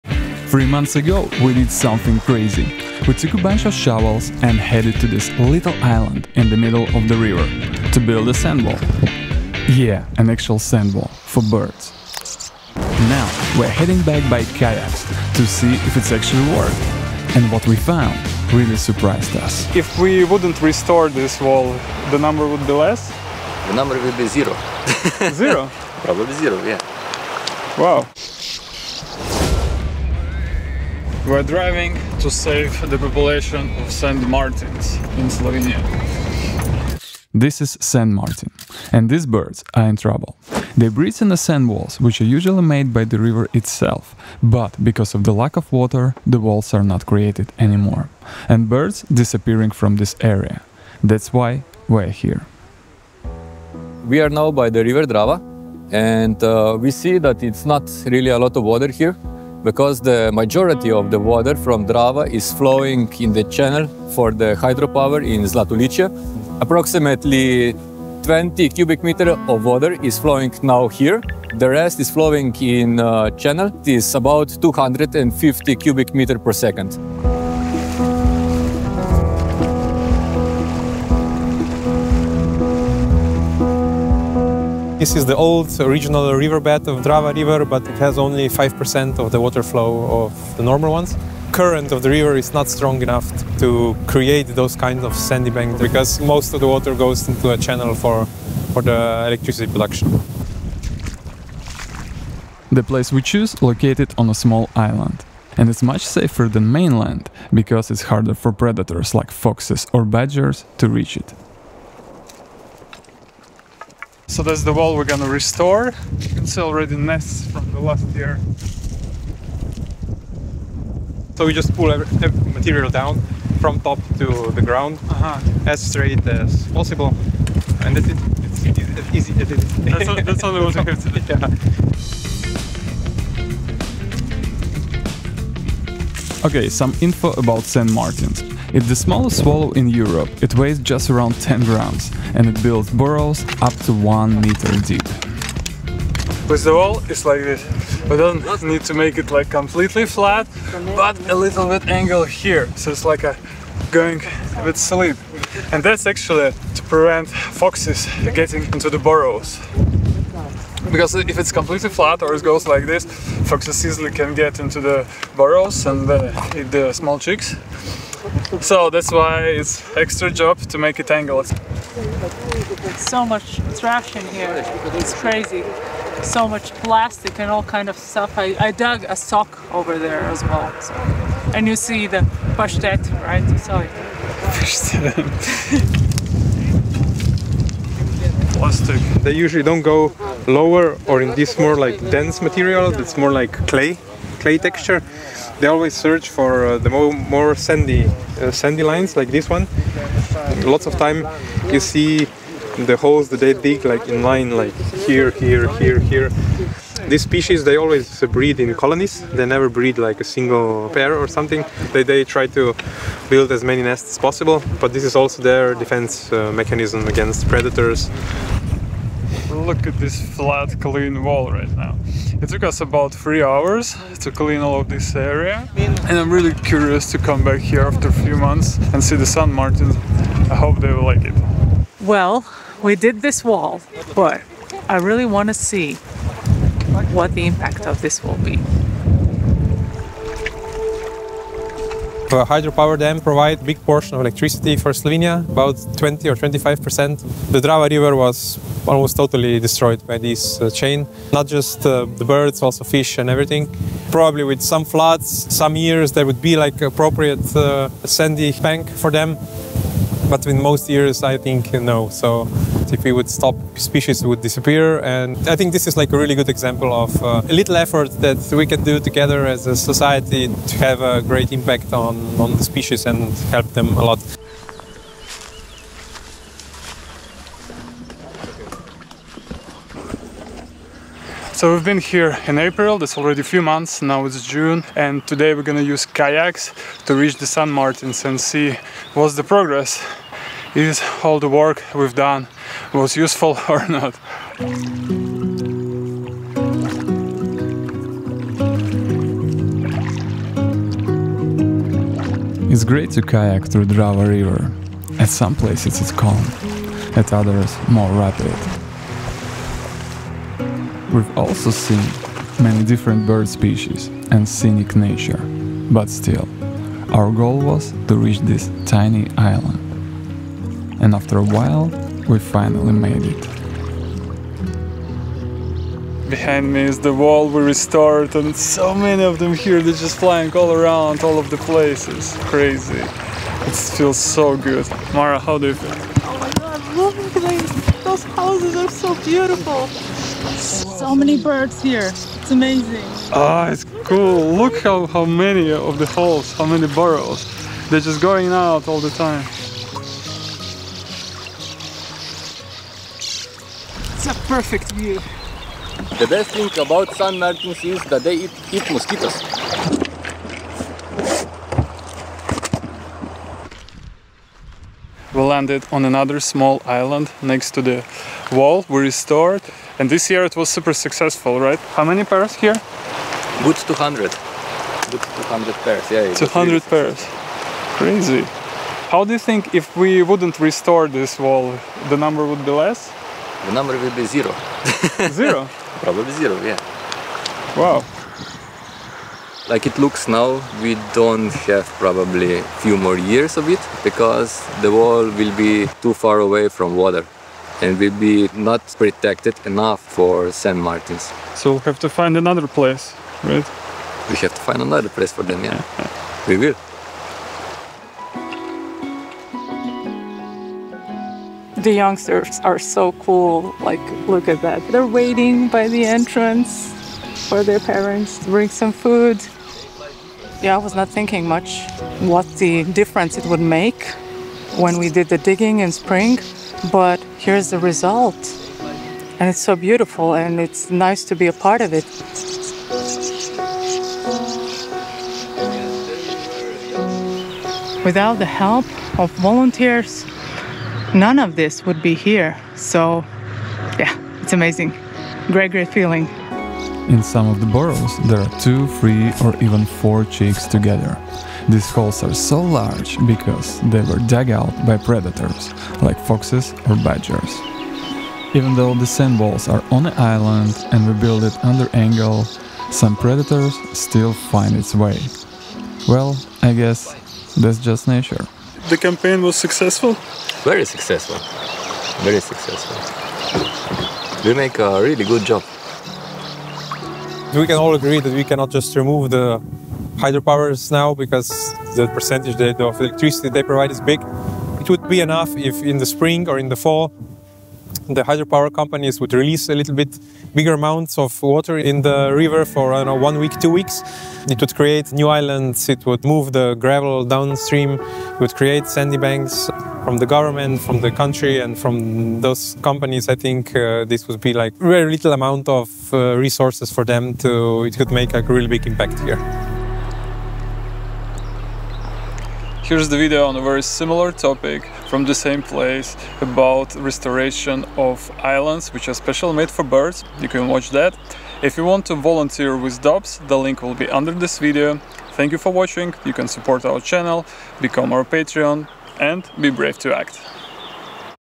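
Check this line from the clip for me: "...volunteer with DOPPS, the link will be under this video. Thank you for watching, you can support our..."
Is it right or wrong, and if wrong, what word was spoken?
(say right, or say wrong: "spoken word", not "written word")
right.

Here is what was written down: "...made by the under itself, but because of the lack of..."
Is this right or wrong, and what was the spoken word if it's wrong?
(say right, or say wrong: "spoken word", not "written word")
wrong: "river", not "under".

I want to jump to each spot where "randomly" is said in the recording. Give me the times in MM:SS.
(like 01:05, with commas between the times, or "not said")
not said.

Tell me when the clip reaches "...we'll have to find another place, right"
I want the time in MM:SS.
06:41.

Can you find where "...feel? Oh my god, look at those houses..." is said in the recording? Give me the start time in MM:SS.
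05:35.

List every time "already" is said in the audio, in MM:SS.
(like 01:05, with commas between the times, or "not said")
01:56, 04:43.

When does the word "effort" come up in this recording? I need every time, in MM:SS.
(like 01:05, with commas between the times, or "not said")
04:27.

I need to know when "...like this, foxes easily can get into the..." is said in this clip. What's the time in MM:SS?
02:42.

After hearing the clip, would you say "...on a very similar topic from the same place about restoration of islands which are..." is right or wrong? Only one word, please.
right.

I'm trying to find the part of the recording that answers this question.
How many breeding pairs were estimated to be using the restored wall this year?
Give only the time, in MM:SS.
06:13.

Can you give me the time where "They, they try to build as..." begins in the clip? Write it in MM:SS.
03:31.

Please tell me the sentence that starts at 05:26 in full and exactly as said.
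Behind me is the wall we restored and so many of them here, they're just flying all around, all of the places.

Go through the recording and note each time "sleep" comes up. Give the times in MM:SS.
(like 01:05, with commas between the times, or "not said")
02:34.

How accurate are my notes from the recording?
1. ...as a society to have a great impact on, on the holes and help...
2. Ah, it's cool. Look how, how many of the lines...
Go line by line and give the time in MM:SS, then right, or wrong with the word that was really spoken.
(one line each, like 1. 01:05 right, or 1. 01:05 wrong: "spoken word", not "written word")
1. 04:29 wrong: "species", not "holes"
2. 05:43 wrong: "holes", not "lines".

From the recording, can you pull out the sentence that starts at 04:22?
So if we would stop, species would disappear.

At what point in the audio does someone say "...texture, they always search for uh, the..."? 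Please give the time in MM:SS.
03:14.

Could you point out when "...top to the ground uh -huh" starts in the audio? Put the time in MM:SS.
02:03.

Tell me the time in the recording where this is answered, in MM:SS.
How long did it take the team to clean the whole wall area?
03:43.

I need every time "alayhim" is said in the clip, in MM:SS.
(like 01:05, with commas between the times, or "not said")
not said.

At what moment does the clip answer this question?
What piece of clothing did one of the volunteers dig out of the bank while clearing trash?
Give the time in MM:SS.
02:59.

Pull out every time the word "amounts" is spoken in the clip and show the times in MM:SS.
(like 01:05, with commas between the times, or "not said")
08:10, 08:25.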